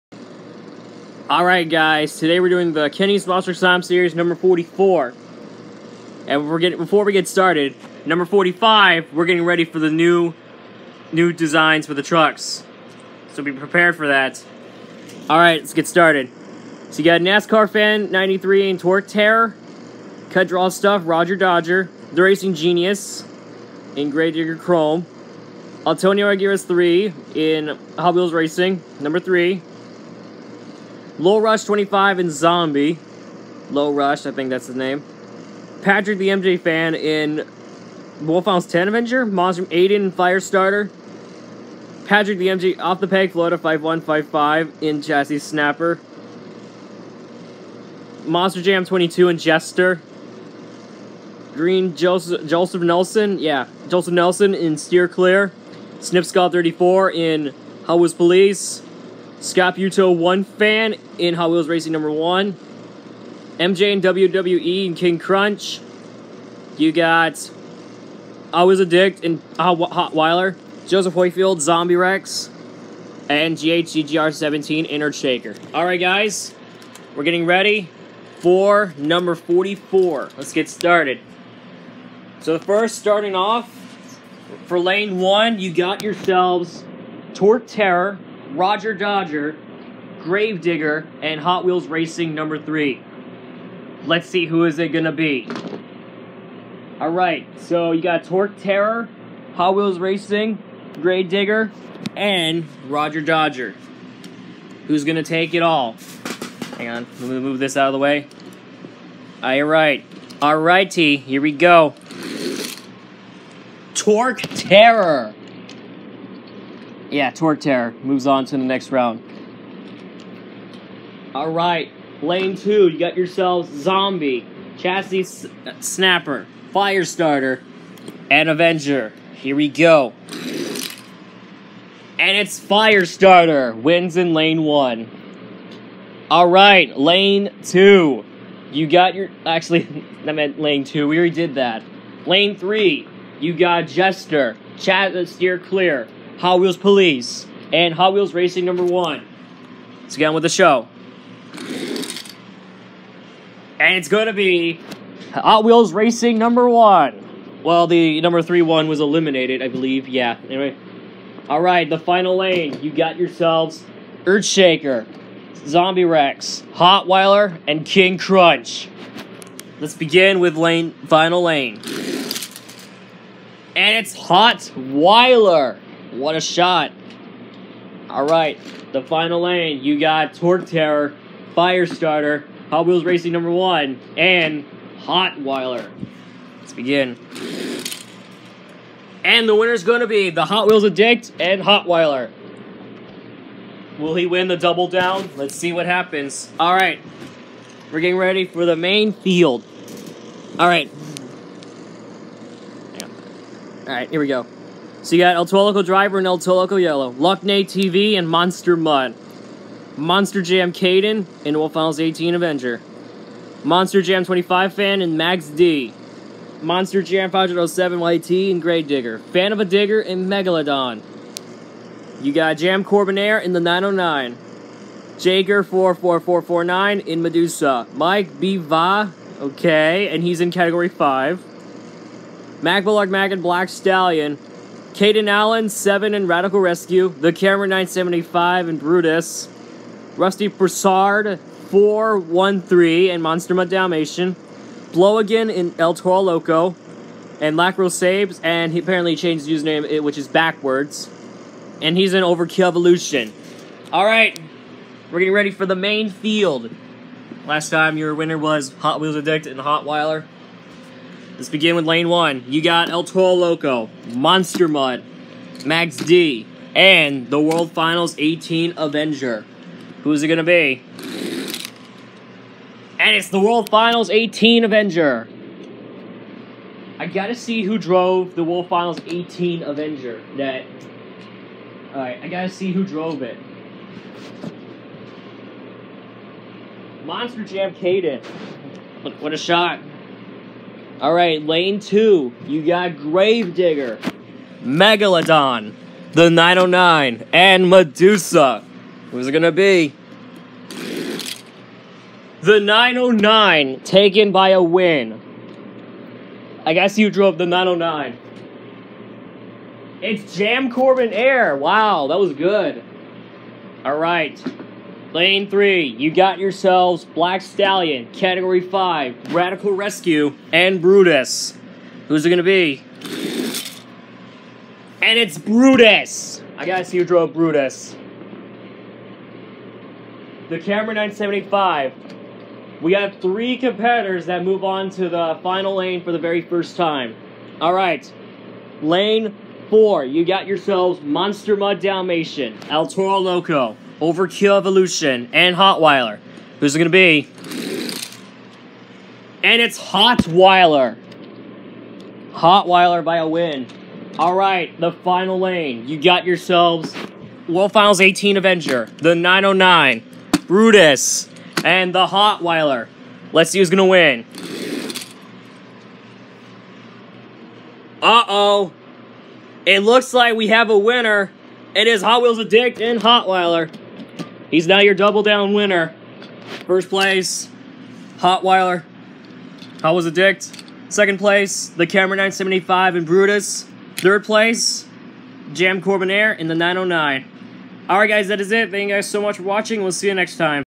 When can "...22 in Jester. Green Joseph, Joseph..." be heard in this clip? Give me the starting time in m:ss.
0:48.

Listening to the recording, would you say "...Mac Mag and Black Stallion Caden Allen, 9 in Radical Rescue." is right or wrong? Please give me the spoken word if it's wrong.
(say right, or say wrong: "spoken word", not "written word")
wrong: "7", not "9".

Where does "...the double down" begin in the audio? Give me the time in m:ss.
3:14.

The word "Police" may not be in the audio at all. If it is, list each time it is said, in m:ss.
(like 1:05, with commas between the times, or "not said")
0:58, 2:26.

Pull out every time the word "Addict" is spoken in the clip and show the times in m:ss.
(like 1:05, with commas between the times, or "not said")
1:08, 3:10, 4:19, 6:12, 6:20.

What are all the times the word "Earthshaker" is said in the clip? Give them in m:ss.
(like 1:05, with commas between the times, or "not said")
1:15, 2:44.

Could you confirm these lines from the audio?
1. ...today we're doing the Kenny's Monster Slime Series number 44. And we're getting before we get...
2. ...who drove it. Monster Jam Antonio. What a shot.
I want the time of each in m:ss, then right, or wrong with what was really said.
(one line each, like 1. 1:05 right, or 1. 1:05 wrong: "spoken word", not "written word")
1. 0:02 right
2. 4:42 wrong: "Caden", not "Antonio".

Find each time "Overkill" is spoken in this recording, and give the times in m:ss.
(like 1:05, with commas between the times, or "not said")
4:12, 5:44.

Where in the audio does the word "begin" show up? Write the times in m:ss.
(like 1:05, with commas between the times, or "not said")
2:49, 3:06, 4:21.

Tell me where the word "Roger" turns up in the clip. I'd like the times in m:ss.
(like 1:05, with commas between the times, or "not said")
0:21, 1:28, 1:42.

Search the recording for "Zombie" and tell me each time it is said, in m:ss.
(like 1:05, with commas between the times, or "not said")
0:32, 1:11, 2:03, 2:45.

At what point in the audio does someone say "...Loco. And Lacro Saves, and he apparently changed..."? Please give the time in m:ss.
4:06.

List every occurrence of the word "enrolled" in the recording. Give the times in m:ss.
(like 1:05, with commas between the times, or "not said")
not said.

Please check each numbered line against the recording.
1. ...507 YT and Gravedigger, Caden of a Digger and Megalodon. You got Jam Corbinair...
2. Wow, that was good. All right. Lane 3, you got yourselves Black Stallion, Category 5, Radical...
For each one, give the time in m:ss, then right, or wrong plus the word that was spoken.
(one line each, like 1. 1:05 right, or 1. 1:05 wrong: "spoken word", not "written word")
1. 3:37 wrong: "Fan", not "Caden"
2. 5:11 right.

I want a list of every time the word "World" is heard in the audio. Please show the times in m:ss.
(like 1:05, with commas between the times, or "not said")
3:31, 4:27, 4:33, 4:38, 5:57.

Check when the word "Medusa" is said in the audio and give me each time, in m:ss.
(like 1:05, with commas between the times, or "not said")
3:47, 4:57.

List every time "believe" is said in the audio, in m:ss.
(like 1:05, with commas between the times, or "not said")
2:39.